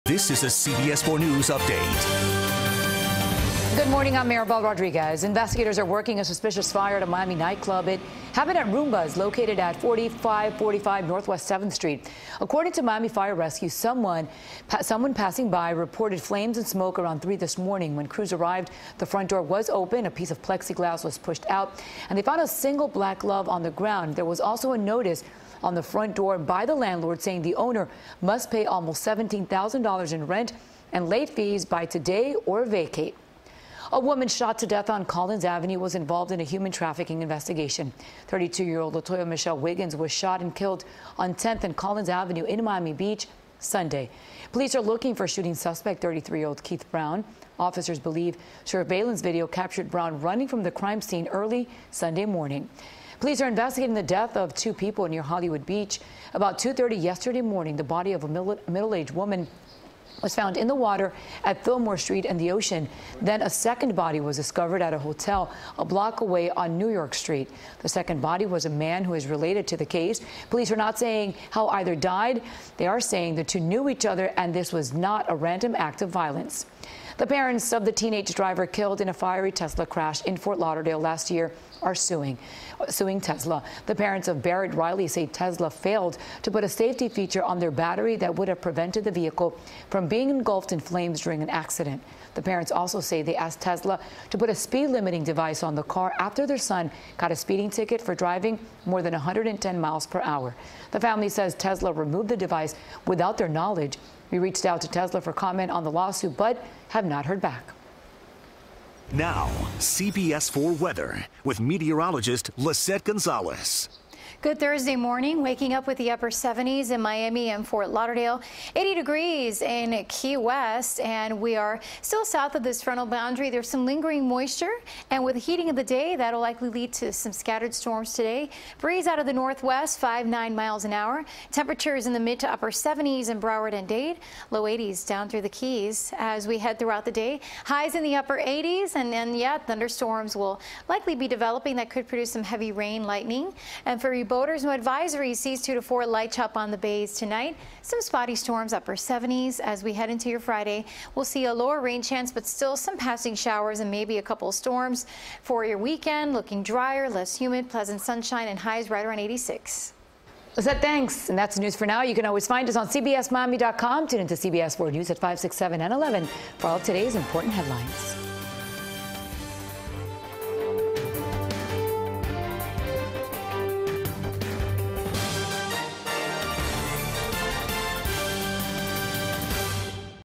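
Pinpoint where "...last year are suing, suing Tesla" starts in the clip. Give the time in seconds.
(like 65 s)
80 s.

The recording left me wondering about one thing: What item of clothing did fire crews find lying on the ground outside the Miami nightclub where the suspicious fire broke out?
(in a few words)
a single black glove.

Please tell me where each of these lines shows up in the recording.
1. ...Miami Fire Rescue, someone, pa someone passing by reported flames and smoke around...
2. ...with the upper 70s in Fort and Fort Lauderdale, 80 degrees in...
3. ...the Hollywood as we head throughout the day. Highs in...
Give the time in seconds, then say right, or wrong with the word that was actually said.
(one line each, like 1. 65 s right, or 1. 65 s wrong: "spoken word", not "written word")
1. 12 s right
2. 115 s wrong: "Miami", not "Fort"
3. 135 s wrong: "Keys", not "Hollywood".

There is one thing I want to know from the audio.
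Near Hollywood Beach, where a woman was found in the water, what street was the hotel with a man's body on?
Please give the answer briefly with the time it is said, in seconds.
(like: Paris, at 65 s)
New York Street, at 66 s.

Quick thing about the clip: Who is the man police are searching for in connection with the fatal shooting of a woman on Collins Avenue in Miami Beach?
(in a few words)
Keith Brown.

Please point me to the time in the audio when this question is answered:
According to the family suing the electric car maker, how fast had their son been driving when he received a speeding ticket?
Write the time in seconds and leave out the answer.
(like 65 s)
98 s.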